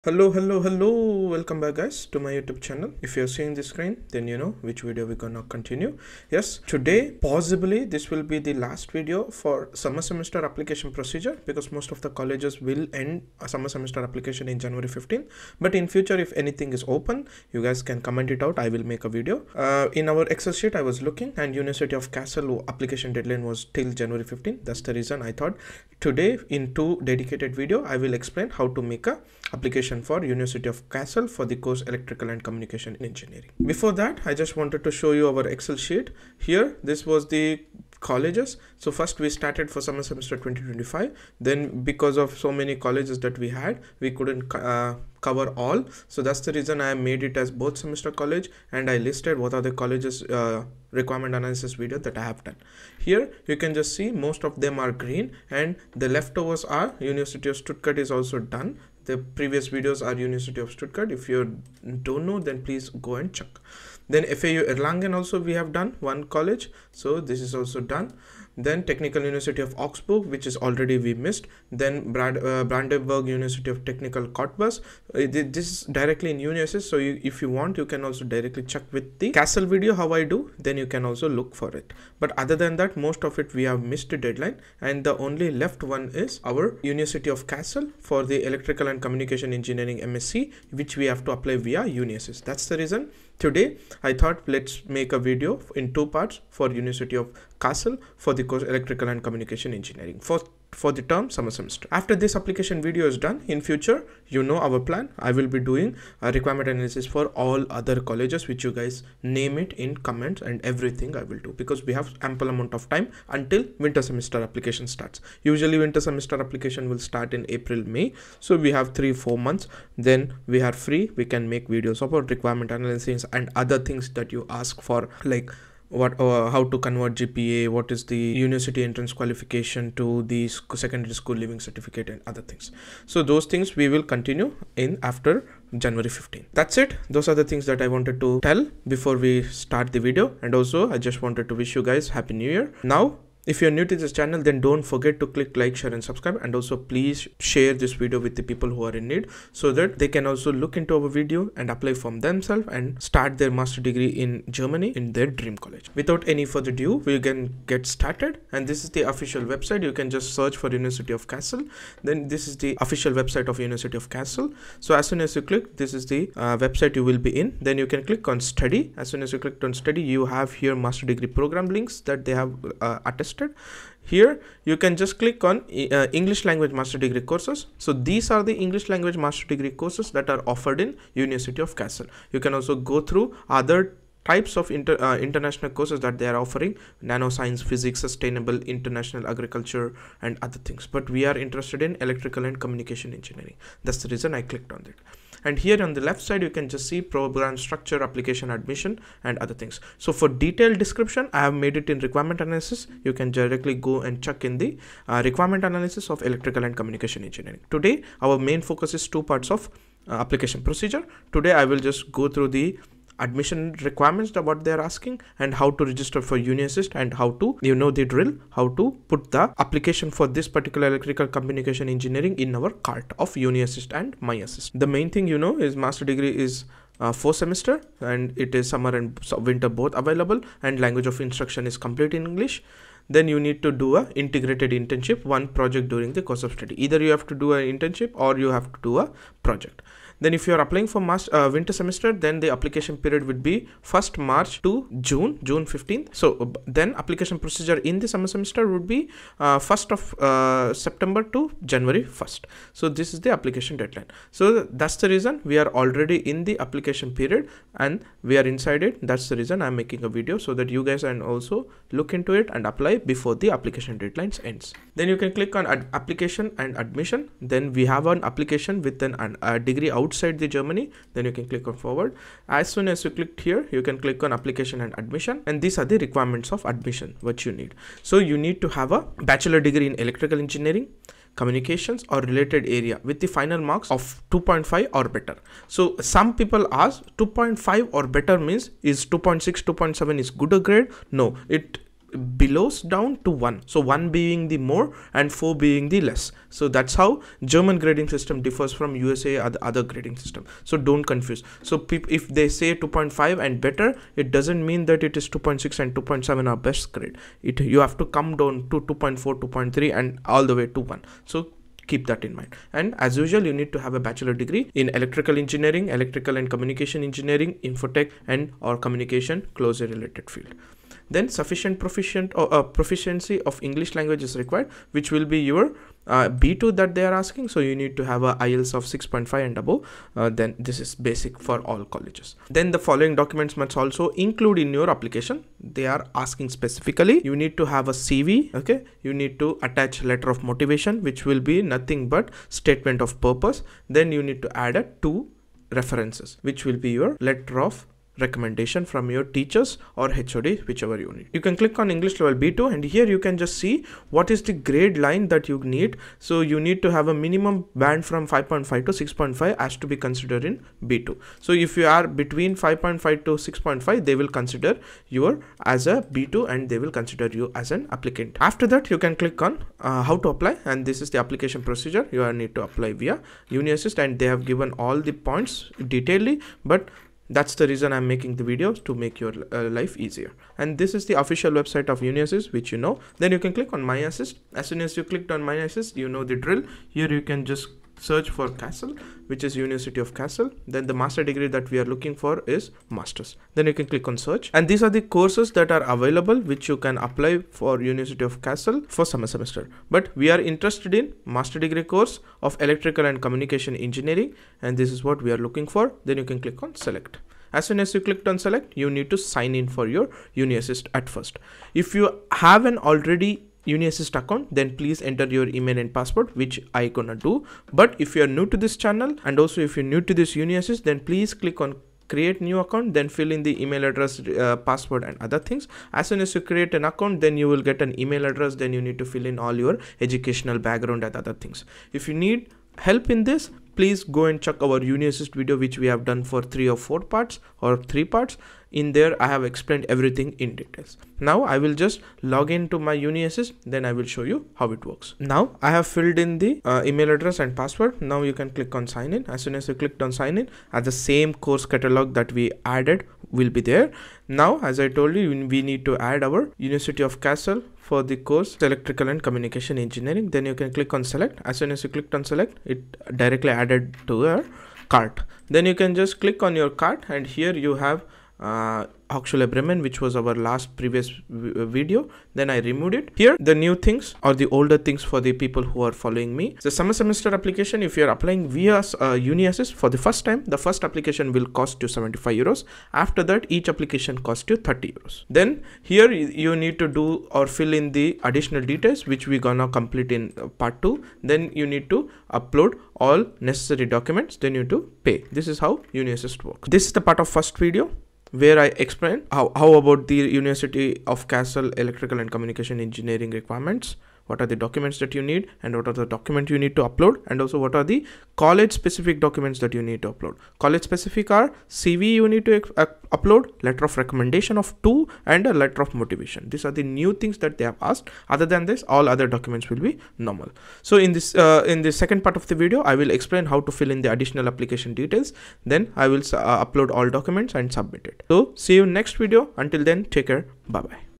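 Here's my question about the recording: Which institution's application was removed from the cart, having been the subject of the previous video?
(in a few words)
Hochschule Bremen.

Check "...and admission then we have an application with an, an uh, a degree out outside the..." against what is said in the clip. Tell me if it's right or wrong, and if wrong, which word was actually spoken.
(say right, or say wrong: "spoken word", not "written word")
right.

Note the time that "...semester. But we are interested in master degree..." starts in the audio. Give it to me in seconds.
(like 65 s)
399 s.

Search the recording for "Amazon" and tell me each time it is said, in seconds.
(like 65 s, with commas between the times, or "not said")
not said.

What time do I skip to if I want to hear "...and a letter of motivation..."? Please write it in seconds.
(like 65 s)
515 s.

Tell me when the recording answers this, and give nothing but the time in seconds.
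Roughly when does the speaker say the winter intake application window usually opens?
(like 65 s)
117 s.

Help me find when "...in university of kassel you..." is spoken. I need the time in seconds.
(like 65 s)
180 s.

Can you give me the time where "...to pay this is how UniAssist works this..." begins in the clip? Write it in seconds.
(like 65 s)
494 s.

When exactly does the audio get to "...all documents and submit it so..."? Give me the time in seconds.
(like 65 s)
527 s.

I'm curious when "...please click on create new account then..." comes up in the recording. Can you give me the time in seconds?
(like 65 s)
421 s.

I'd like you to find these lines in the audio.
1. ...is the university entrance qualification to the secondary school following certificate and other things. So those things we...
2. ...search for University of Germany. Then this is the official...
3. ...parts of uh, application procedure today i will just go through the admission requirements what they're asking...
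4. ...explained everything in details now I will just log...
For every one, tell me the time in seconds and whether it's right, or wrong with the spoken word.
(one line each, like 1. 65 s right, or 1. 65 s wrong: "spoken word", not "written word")
1. 127 s wrong: "leaving", not "following"
2. 160 s wrong: "Kassel", not "Germany"
3. 209 s right
4. 439 s right.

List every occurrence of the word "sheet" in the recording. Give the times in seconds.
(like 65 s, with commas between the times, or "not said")
20 s, 35 s.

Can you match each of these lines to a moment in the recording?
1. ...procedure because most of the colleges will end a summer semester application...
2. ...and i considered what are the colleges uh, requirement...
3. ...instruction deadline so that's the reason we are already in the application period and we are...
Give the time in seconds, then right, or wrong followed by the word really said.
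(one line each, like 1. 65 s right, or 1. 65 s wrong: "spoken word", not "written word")
1. 10 s right
2. 48 s wrong: "listed", not "considered"
3. 253 s wrong: "application", not "instruction".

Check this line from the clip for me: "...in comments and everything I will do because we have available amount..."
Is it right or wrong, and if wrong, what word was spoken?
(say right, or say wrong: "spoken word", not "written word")
wrong: "ample", not "available".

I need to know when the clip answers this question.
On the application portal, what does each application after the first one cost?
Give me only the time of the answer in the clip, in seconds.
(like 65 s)
484 s.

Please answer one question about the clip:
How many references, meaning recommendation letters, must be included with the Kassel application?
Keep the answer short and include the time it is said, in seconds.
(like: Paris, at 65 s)
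2, at 345 s.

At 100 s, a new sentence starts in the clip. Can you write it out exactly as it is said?
For for the term summer semester.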